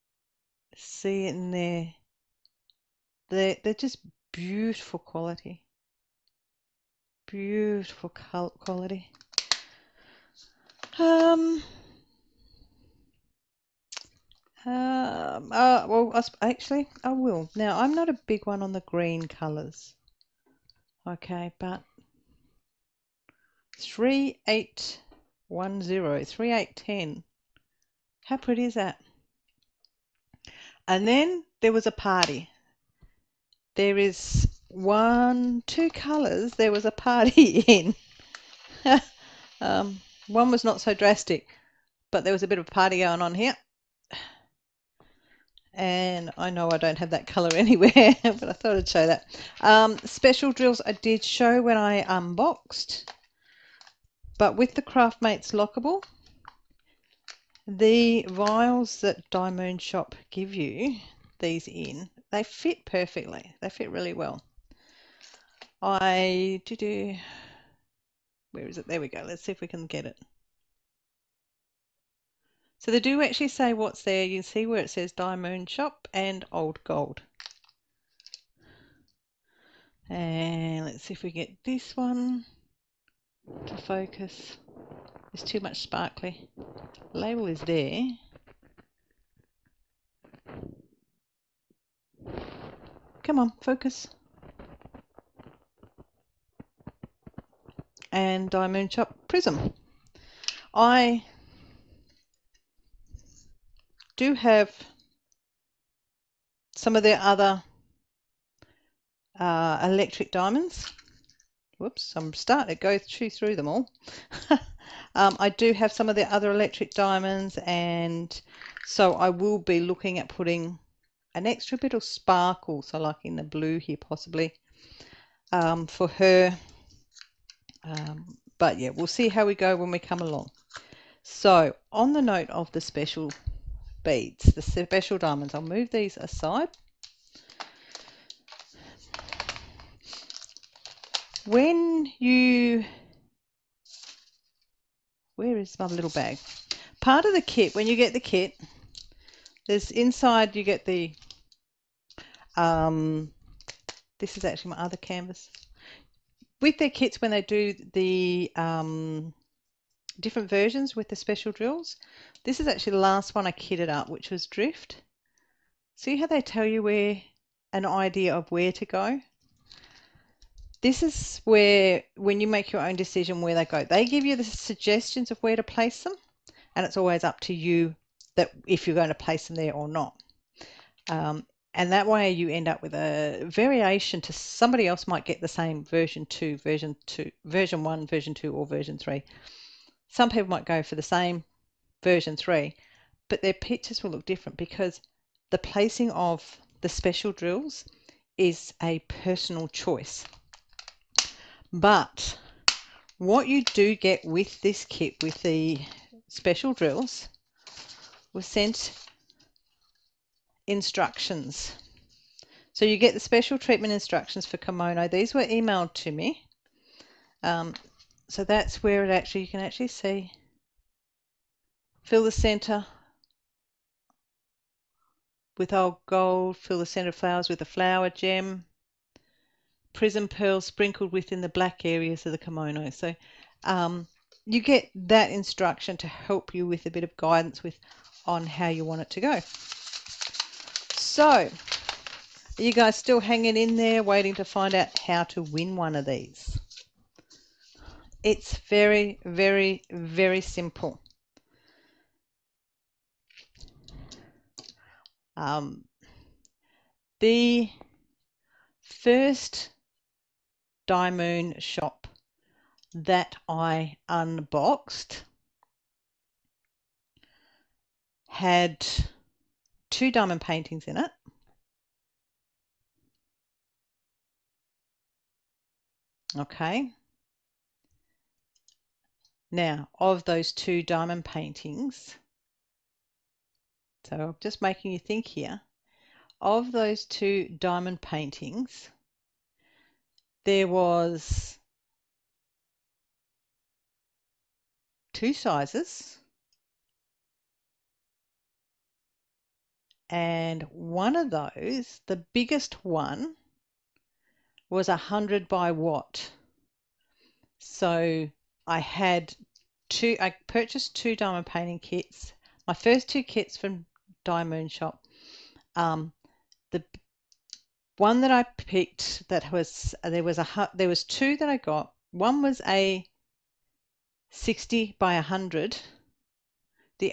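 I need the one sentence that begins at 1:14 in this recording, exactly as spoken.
You see where it says DIYMoon Shop and Old Gold.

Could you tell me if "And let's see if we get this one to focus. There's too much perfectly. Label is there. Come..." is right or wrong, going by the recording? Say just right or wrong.
wrong.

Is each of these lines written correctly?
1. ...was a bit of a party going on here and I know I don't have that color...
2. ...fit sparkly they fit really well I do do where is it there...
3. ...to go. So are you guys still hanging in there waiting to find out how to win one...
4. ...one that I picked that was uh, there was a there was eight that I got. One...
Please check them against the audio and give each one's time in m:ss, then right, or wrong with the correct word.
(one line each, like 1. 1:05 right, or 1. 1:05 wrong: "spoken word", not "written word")
1. 0:42 right
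2. 1:02 wrong: "perfectly", not "sparkly"
3. 3:59 right
4. 5:17 wrong: "two", not "eight".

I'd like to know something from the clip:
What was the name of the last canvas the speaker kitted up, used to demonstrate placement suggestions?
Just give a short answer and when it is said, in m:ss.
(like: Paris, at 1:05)
Drift, at 2:44.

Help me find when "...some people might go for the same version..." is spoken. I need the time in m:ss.
3:10.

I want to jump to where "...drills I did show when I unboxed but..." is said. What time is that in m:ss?
0:50.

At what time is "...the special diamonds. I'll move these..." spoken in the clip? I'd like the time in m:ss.
2:14.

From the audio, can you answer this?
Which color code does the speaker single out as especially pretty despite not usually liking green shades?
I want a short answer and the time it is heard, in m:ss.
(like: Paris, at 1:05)
3810, at 0:26.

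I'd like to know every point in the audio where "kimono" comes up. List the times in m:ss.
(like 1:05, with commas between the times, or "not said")
3:34, 3:52.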